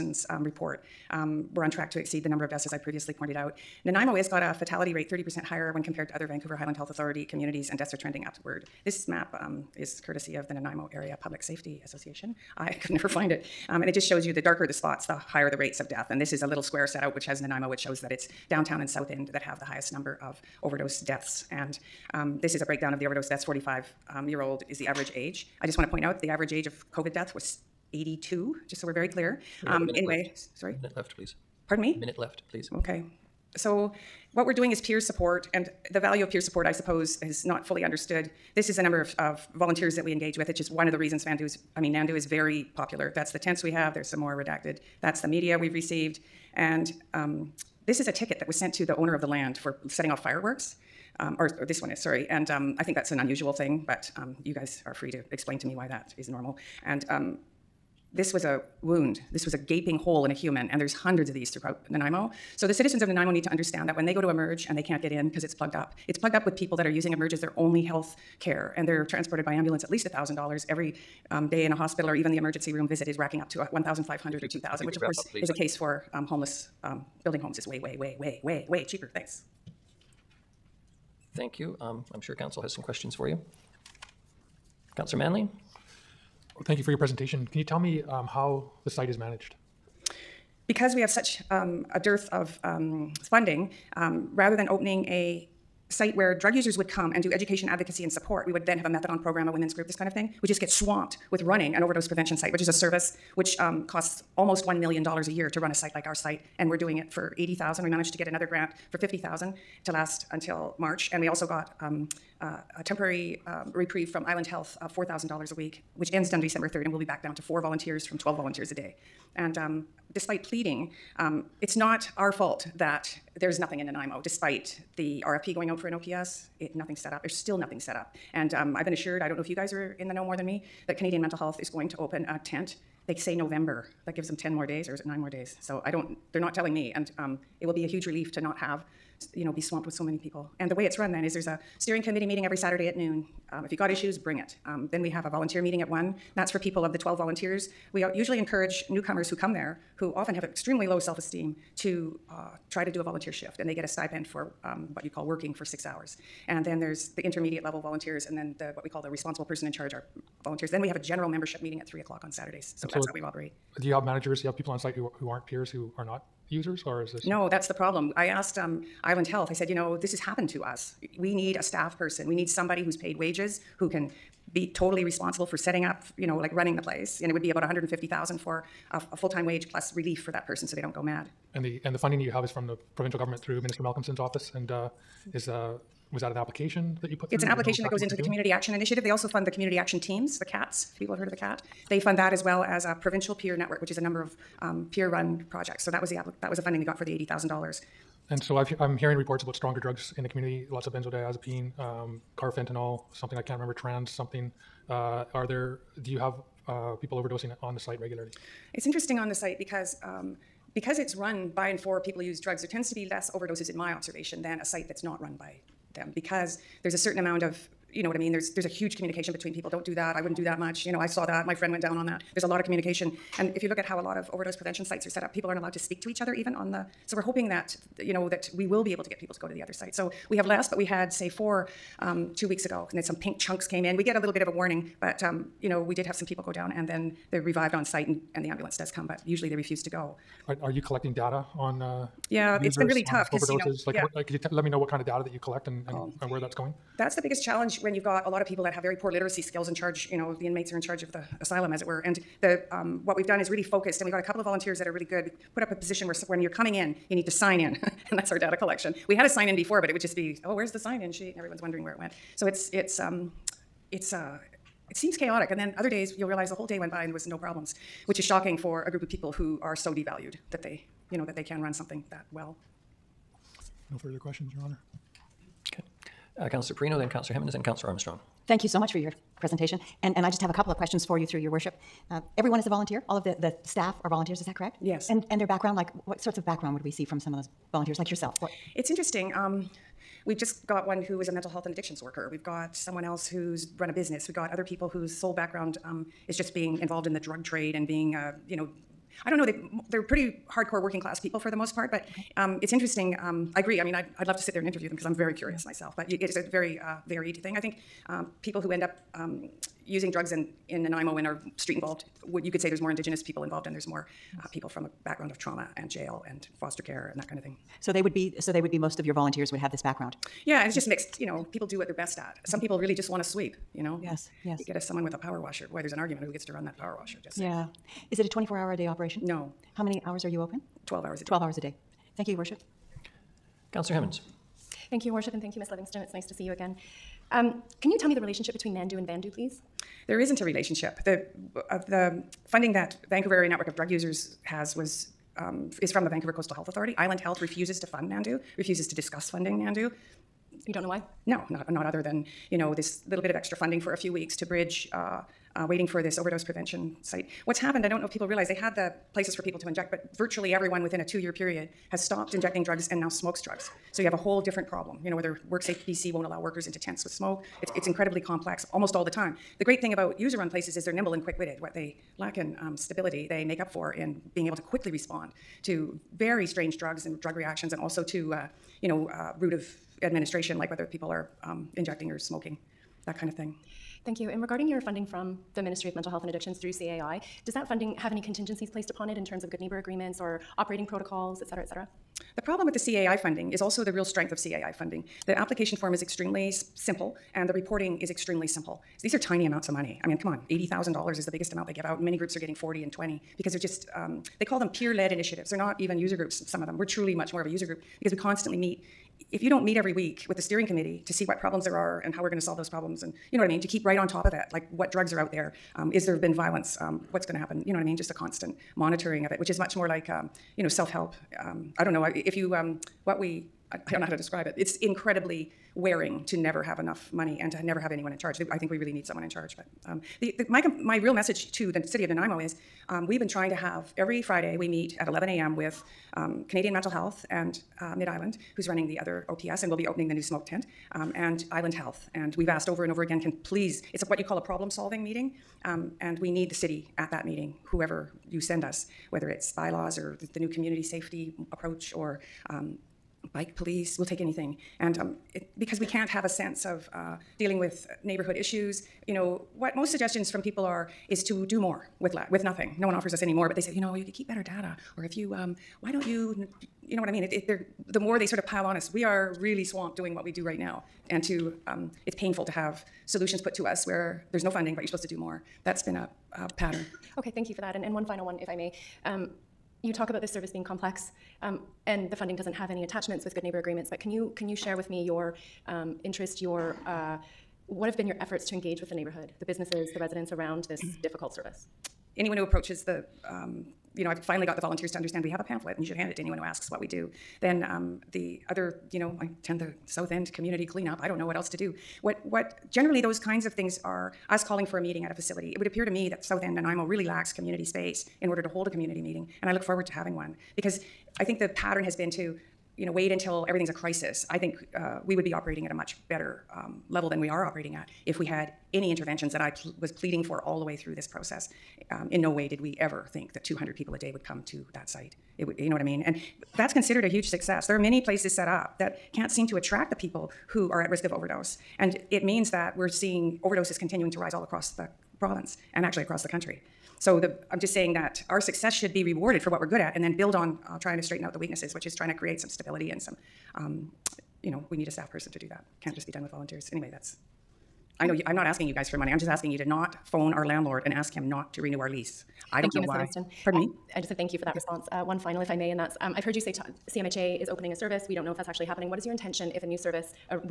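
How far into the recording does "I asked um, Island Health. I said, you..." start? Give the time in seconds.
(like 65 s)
168 s.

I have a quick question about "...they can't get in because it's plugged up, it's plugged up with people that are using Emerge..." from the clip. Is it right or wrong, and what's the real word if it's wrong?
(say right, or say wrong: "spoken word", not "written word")
right.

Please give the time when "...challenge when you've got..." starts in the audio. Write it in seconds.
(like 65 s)
247 s.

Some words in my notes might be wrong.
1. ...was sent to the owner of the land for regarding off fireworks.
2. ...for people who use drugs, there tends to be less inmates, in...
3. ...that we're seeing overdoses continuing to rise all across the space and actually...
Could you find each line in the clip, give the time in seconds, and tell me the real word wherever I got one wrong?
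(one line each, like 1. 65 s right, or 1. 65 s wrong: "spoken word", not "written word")
1. 48 s wrong: "setting", not "regarding"
2. 211 s wrong: "overdoses", not "inmates"
3. 532 s wrong: "province", not "space".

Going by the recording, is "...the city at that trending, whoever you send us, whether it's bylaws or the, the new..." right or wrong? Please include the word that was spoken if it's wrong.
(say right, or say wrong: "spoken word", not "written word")
wrong: "meeting", not "trending".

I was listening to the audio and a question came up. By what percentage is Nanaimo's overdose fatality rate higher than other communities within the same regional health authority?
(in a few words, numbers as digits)
30%.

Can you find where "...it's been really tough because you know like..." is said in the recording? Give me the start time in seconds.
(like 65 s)
242 s.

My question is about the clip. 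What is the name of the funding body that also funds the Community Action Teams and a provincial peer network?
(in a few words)
Community Action Initiative.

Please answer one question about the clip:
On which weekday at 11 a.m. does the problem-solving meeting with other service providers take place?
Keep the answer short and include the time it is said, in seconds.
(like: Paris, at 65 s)
Friday, at 434 s.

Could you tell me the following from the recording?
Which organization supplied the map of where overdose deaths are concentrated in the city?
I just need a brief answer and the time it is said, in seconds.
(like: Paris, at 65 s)
Nanaimo Area Public Safety Association, at 10 s.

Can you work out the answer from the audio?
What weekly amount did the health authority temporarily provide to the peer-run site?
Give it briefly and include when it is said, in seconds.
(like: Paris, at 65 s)
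$4,000, at 114 s.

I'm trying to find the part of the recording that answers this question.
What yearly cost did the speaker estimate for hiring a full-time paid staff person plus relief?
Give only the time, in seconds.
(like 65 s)
177 s.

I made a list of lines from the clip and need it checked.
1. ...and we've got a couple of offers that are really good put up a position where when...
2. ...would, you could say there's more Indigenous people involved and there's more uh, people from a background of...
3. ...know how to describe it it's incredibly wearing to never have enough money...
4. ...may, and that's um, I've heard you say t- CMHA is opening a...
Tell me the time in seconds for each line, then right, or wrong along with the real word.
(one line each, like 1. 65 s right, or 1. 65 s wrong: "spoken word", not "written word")
1. 253 s wrong: "volunteers", not "offers"
2. 312 s right
3. 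424 s right
4. 555 s right.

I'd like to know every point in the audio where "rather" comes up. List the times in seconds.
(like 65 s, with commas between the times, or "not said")
94 s.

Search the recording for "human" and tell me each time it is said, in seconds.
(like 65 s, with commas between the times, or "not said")
60 s.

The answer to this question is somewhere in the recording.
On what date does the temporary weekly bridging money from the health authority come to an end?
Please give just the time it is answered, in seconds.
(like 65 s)
116 s.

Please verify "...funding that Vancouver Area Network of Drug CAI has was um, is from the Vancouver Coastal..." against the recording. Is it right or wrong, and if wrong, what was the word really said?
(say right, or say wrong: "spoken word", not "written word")
wrong: "Users", not "CAI".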